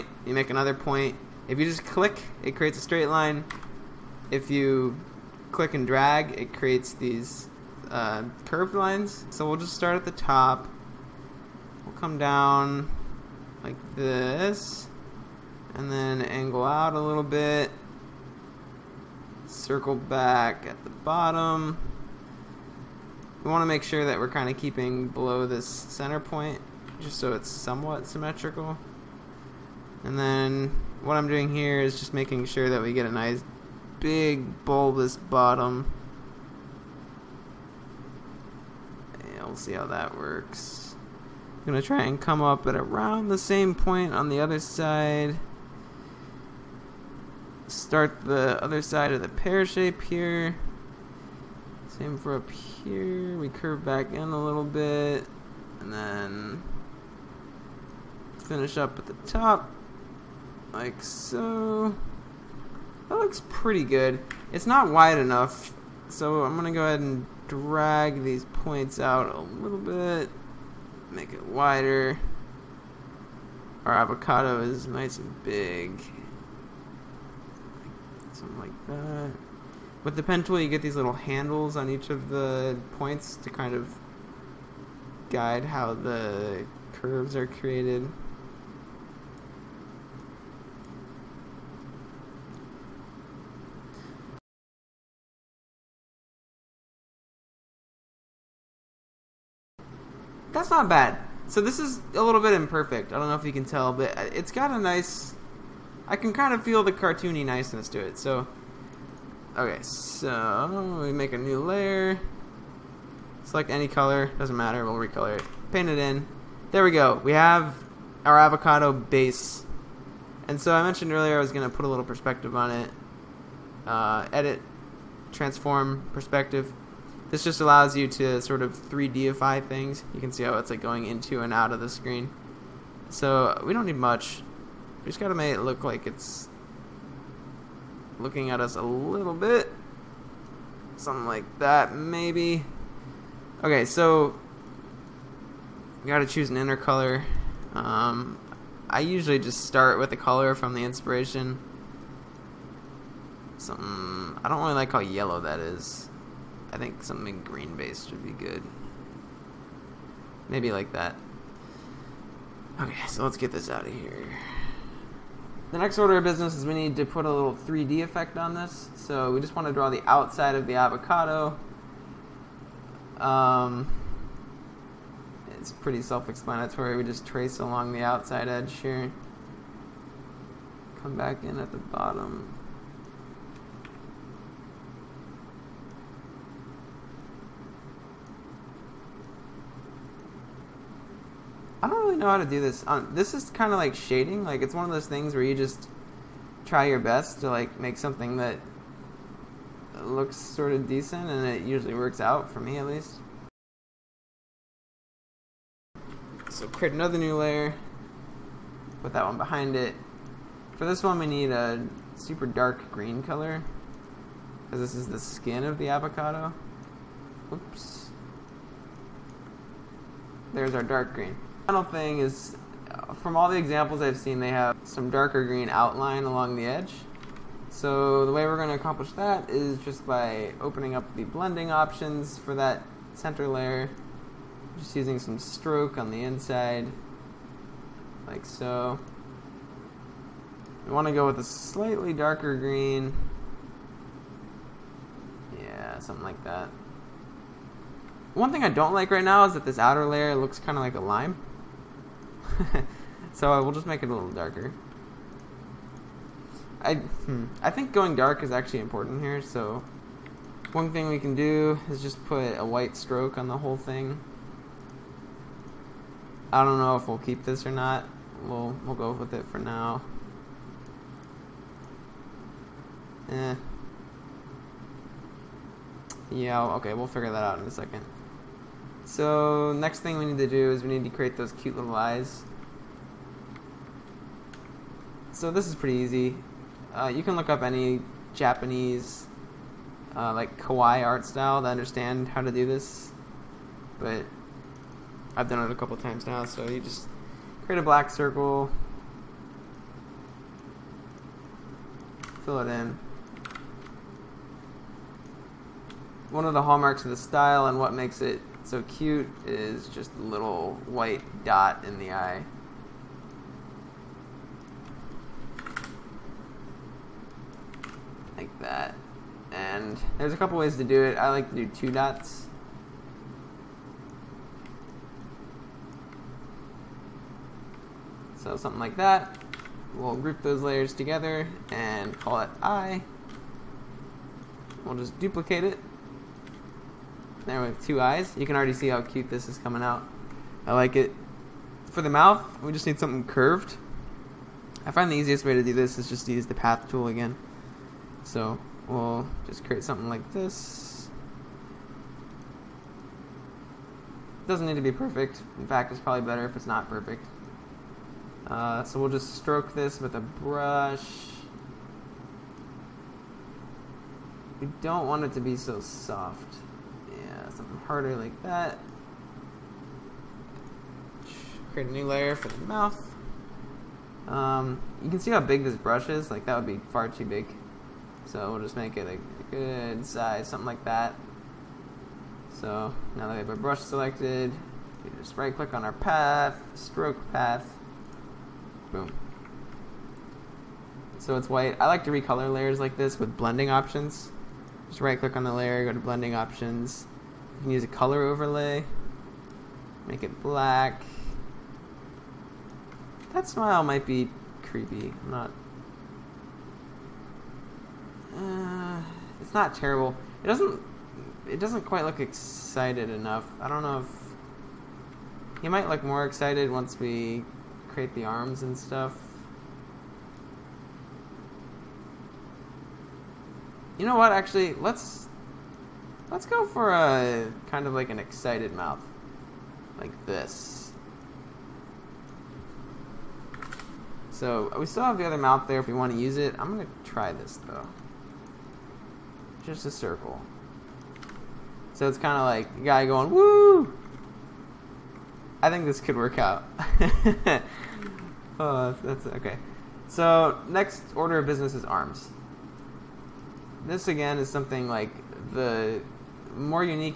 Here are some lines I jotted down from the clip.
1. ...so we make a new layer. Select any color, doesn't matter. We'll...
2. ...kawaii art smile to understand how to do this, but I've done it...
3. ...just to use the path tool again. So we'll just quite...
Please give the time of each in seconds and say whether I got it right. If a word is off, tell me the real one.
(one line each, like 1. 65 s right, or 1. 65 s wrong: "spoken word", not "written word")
1. 109 s right
2. 290 s wrong: "style", not "smile"
3. 346 s wrong: "create", not "quite".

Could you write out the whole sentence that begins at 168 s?
So we just want to draw the outside of the avocado.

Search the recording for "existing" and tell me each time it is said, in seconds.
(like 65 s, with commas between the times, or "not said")
not said.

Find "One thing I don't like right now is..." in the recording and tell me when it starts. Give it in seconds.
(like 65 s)
248 s.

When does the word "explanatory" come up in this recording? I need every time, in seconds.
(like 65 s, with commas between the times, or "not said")
176 s.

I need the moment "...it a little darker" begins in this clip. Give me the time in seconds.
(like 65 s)
254 s.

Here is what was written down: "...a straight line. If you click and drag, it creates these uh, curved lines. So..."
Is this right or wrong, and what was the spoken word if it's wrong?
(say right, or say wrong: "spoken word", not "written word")
right.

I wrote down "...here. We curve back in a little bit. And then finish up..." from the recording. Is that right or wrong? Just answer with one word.
right.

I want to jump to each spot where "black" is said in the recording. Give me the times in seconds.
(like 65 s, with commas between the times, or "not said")
297 s, 400 s.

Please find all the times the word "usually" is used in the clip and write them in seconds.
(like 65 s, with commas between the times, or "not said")
149 s, 201 s.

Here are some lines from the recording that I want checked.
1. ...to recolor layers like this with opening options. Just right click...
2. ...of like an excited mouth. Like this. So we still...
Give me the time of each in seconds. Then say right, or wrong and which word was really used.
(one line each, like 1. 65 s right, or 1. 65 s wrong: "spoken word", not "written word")
1. 392 s wrong: "blending", not "opening"
2. 427 s right.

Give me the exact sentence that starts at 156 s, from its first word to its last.
I think something green based would be good.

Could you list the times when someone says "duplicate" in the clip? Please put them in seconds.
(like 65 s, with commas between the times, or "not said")
335 s.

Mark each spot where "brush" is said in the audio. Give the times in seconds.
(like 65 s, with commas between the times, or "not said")
360 s, 375 s, 383 s.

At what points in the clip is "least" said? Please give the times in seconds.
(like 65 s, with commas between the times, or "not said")
202 s.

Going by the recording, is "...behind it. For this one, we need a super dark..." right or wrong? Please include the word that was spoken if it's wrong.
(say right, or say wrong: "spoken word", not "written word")
right.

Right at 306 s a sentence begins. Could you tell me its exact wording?
One of the hallmarks of the style and what makes it so cute is just a little white dot in the eye.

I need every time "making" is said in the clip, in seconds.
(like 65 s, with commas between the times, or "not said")
32 s.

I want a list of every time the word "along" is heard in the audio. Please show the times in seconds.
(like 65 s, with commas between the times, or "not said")
177 s, 226 s.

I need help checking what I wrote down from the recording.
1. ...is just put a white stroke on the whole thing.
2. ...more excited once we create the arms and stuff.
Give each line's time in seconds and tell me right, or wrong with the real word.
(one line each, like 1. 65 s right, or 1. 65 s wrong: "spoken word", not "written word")
1. 261 s right
2. 416 s right.